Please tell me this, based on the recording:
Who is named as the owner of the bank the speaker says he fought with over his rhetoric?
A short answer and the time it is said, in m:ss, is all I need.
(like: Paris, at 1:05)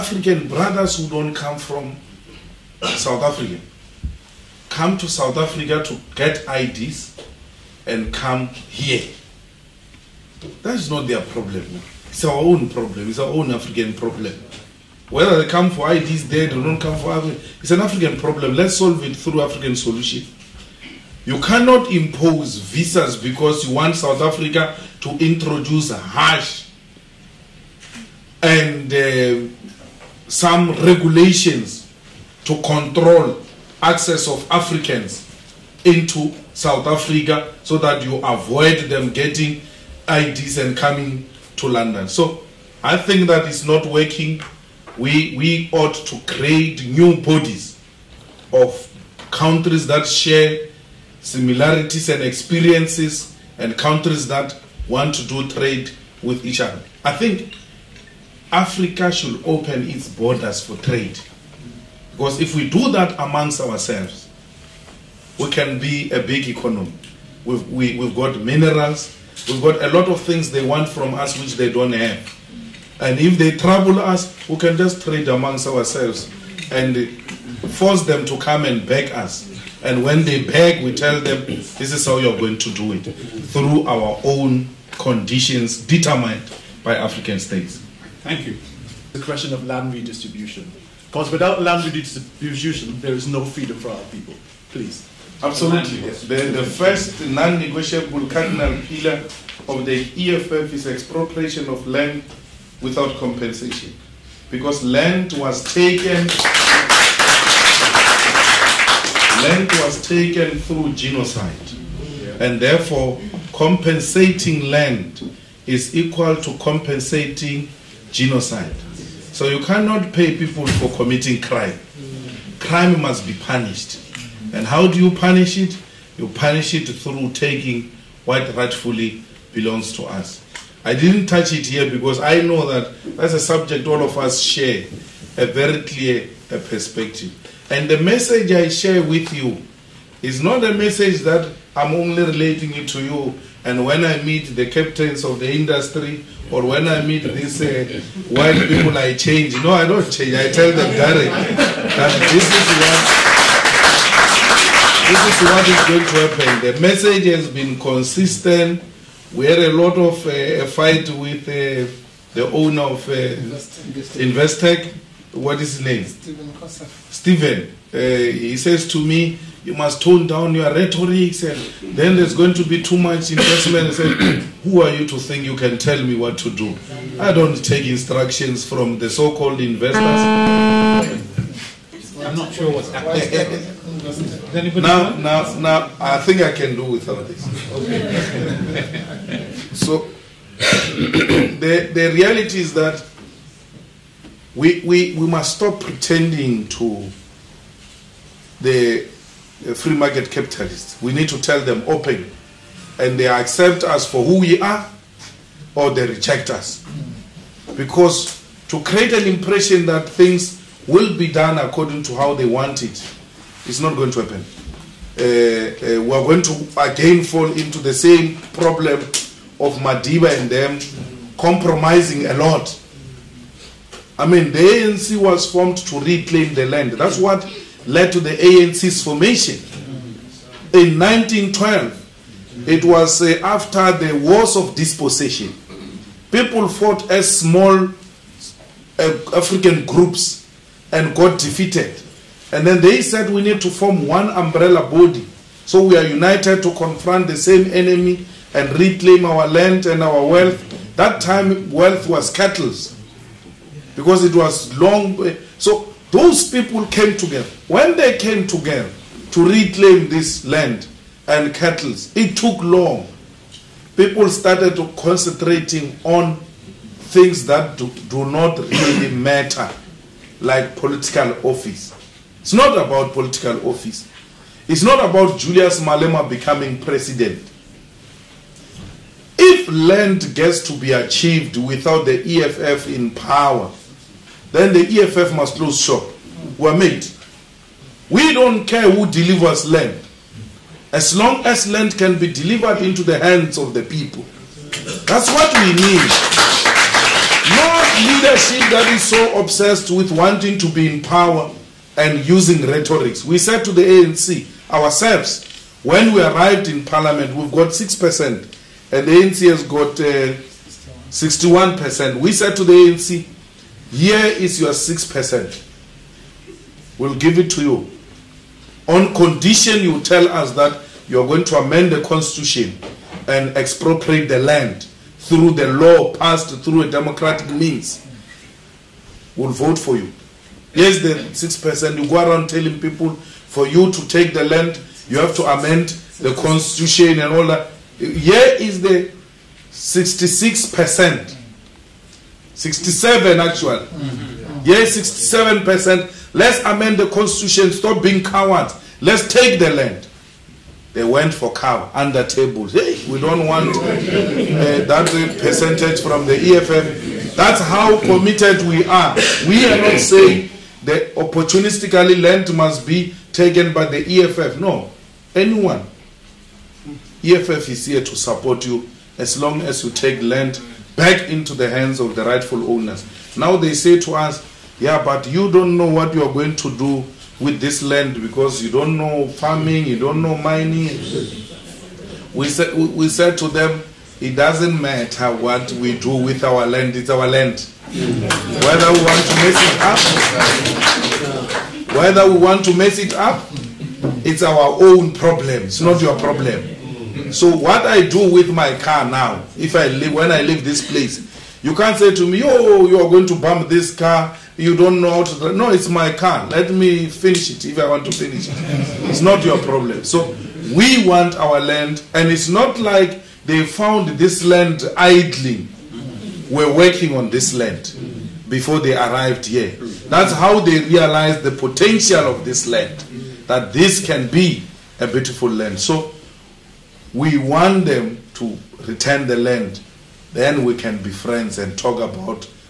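Stephen Koseff, at 2:46.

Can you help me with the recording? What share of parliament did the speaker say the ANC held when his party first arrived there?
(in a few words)
61%.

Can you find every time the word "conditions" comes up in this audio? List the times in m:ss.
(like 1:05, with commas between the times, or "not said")
1:24, 5:19.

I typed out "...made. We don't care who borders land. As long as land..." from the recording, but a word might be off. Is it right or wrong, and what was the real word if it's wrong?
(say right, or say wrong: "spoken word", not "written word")
wrong: "delivers", not "borders".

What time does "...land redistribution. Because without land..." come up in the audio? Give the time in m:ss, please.
1:29.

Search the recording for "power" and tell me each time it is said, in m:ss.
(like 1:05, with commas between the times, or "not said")
4:43, 5:01.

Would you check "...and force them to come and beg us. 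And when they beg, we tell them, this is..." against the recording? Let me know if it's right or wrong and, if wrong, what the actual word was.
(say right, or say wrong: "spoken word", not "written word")
right.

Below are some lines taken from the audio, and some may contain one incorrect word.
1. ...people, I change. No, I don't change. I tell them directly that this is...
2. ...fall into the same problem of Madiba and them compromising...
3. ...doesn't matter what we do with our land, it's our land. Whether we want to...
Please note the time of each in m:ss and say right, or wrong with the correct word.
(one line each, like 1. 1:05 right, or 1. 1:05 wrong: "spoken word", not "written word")
1. 2:28 right
2. 3:37 right
3. 6:24 right.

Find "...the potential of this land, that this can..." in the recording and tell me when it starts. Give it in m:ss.
7:01.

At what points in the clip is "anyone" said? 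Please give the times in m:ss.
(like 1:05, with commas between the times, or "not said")
6:05.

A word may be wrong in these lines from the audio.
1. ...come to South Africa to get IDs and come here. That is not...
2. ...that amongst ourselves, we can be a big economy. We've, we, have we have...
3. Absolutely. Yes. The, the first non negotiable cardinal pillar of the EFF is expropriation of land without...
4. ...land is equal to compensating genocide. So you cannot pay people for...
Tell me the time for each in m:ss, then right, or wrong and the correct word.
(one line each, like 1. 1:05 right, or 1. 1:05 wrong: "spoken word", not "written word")
1. 0:04 right
2. 1:02 right
3. 1:35 right
4. 1:54 right.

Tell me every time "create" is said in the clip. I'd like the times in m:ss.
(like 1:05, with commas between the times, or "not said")
0:46, 3:28.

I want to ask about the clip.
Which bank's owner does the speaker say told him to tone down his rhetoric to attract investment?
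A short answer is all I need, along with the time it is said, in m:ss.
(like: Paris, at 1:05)
Investec, at 2:44.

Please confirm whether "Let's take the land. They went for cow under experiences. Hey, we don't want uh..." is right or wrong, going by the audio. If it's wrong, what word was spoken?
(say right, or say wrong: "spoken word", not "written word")
wrong: "tables", not "experiences".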